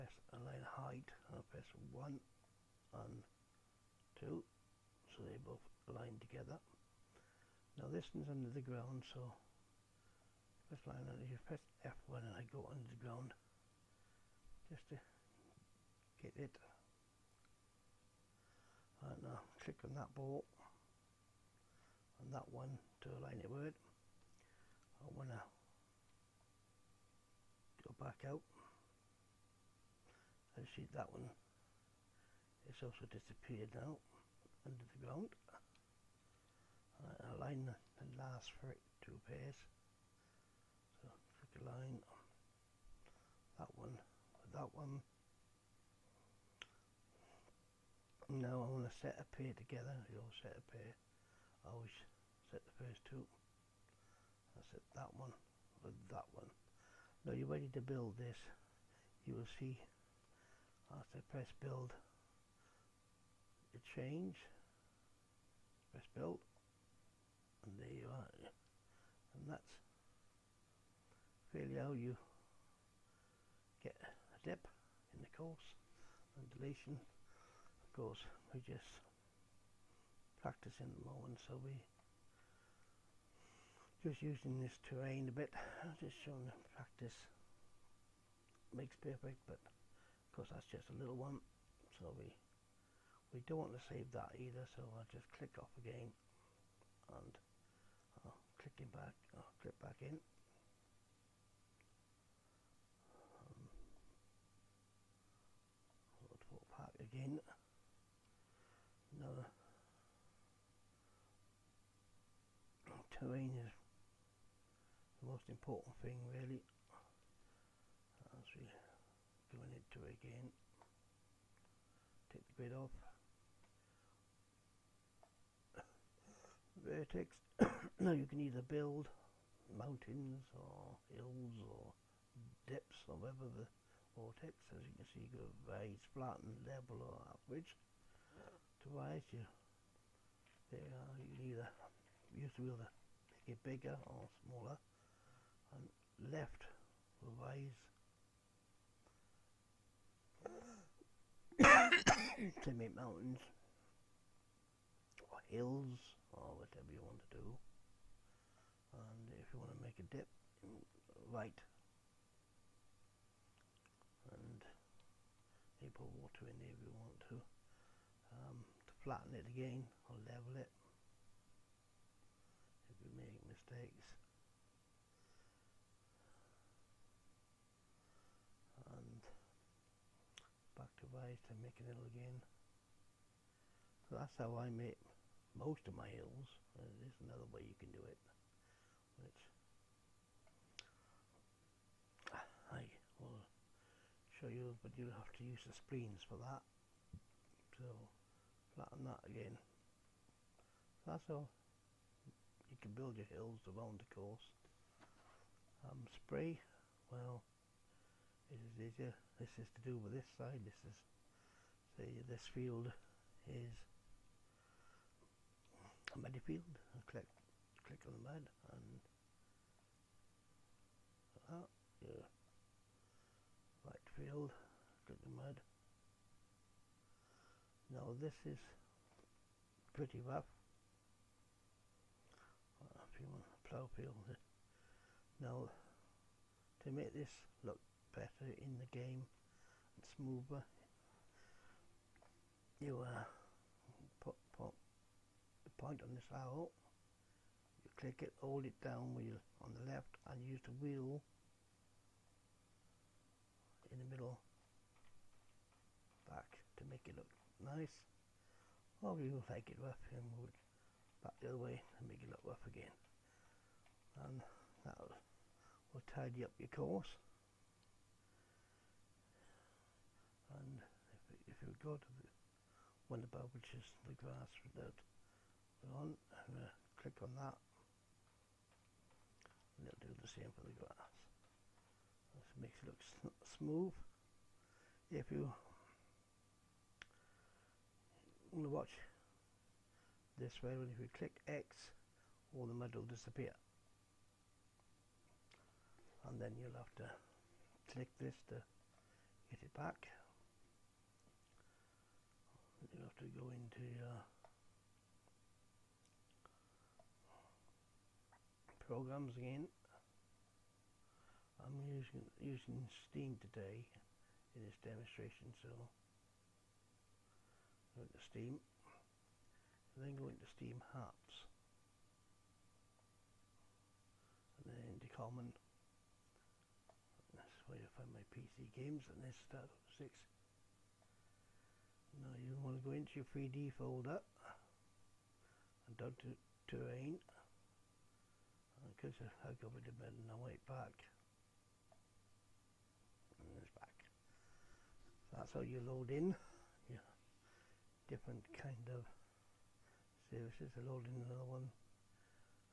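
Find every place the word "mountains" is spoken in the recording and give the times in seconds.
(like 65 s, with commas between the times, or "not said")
129 s, 152 s.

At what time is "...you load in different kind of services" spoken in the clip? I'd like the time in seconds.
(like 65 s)
345 s.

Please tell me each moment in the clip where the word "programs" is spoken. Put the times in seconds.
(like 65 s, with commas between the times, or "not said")
308 s.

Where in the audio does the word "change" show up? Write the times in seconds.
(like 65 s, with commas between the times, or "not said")
63 s.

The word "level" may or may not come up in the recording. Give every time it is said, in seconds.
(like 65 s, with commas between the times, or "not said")
136 s, 170 s.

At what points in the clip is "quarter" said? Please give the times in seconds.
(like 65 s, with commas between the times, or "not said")
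not said.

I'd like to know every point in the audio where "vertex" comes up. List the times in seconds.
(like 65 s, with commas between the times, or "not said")
126 s, 134 s.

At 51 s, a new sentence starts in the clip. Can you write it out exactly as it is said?
I always set the first two.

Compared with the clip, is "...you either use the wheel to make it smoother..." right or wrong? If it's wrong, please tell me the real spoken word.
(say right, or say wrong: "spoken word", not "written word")
wrong: "bigger", not "smoother".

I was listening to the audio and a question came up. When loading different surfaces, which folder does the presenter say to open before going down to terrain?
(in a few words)
3D folder.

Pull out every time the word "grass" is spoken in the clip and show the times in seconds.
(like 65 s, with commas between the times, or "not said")
274 s, 280 s.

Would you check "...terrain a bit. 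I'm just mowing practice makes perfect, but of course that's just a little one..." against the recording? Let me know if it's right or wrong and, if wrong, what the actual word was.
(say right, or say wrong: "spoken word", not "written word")
wrong: "showing", not "mowing".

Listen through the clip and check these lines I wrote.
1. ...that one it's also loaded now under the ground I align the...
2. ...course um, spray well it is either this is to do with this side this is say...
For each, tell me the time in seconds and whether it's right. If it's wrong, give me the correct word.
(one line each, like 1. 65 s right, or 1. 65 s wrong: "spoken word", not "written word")
1. 30 s wrong: "disappeared", not "loaded"
2. 204 s wrong: "easier", not "either".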